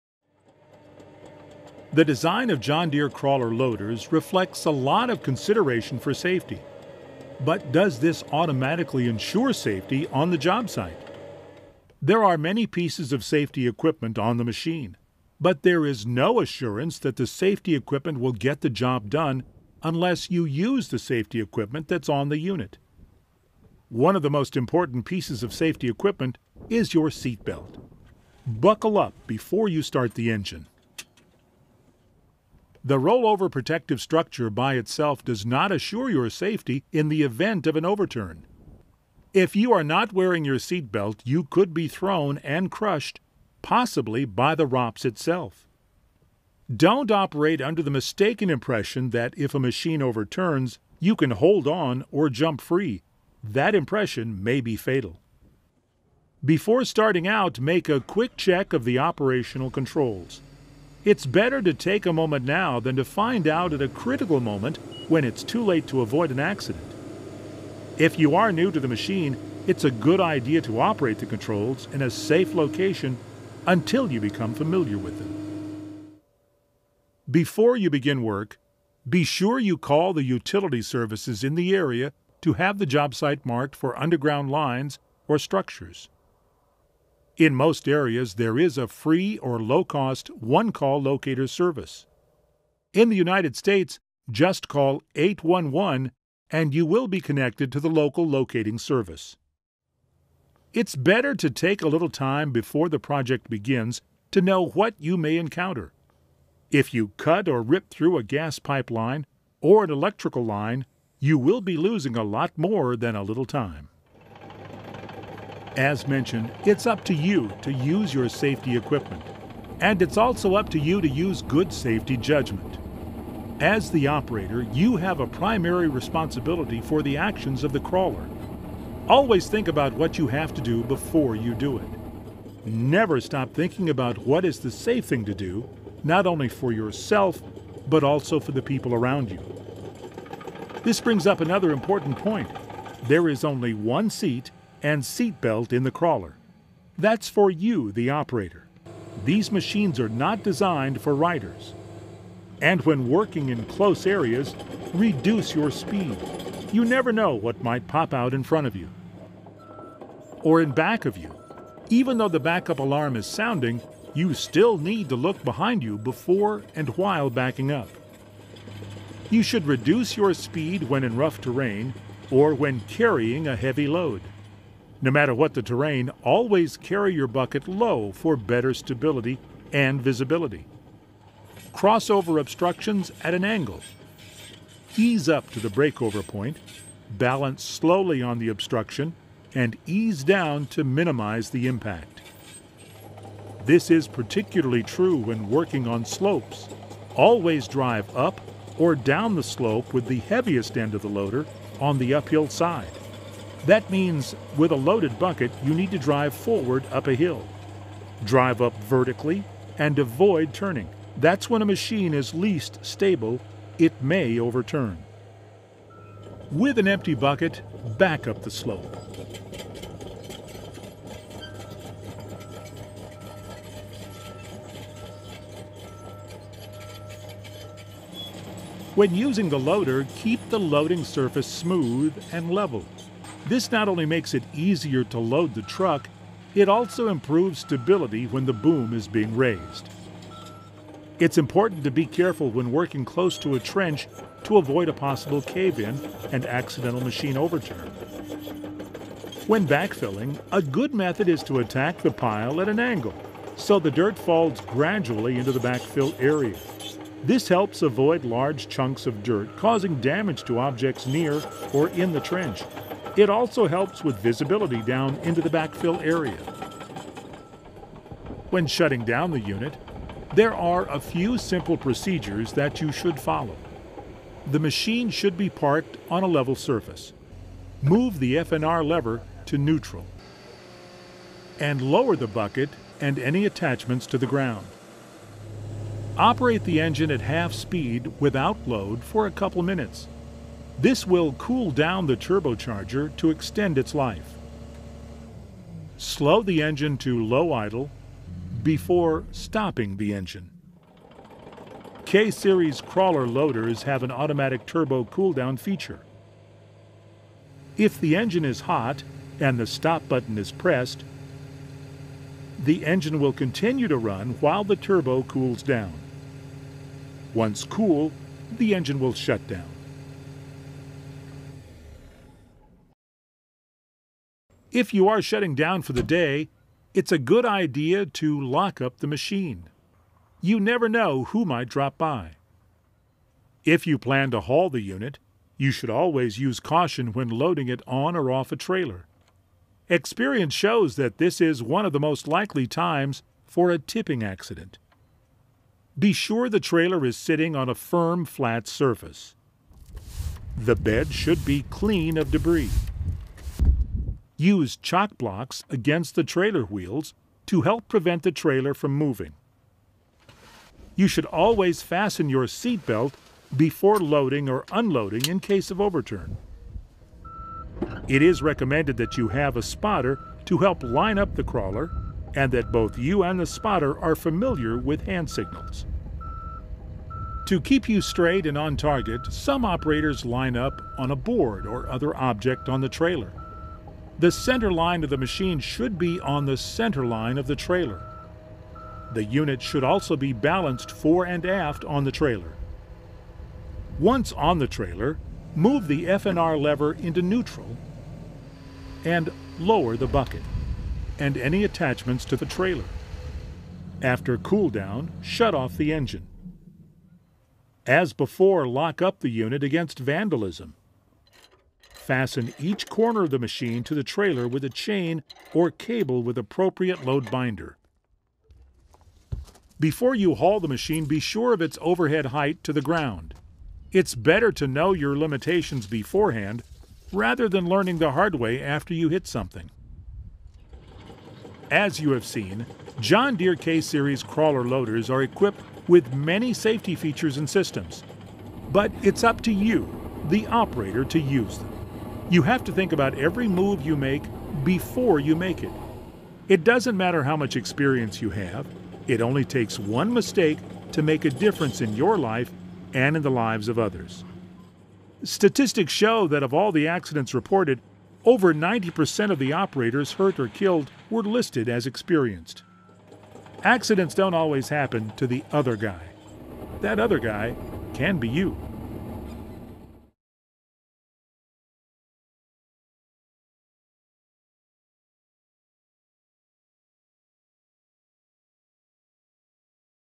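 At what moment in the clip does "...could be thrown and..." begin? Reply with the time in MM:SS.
00:41.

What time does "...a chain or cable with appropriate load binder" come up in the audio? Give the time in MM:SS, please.
06:54.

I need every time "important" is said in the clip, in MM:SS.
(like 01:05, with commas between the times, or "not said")
00:24, 02:21, 04:01.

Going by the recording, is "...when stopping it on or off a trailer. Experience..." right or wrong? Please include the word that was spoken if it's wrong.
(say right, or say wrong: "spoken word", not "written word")
wrong: "loading", not "stopping".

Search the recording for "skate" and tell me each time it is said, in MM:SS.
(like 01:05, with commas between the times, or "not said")
not said.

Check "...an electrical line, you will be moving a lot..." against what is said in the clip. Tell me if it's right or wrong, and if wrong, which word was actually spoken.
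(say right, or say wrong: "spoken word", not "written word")
wrong: "losing", not "moving".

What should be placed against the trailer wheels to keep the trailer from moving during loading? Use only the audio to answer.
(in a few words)
Chock blocks.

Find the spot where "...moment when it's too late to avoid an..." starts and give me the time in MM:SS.
01:04.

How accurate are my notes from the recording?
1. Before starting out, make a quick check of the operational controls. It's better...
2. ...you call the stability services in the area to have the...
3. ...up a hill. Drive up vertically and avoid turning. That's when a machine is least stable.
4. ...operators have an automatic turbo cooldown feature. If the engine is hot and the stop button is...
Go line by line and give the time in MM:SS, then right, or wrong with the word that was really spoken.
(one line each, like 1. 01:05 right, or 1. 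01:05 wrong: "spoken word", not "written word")
1. 00:56 right
2. 01:19 wrong: "utility", not "stability"
3. 03:26 right
4. 05:03 wrong: "loaders", not "operators".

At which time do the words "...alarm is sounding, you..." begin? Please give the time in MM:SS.
02:42.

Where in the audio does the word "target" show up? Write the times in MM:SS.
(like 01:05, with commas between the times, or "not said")
06:18.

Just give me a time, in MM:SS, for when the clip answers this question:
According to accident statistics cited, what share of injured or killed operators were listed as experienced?
07:38.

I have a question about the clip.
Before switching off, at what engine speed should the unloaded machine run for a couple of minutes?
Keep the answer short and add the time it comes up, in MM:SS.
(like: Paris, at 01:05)
Half speed, at 04:47.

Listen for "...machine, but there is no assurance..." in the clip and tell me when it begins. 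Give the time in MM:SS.
00:14.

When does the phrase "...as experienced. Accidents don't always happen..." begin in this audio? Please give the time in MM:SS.
07:41.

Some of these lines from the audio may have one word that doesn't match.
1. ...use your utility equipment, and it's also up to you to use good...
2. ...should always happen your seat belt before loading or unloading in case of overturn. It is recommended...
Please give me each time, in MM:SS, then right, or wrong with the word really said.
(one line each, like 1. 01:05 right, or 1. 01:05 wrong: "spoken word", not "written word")
1. 01:57 wrong: "safety", not "utility"
2. 06:01 wrong: "fasten", not "happen".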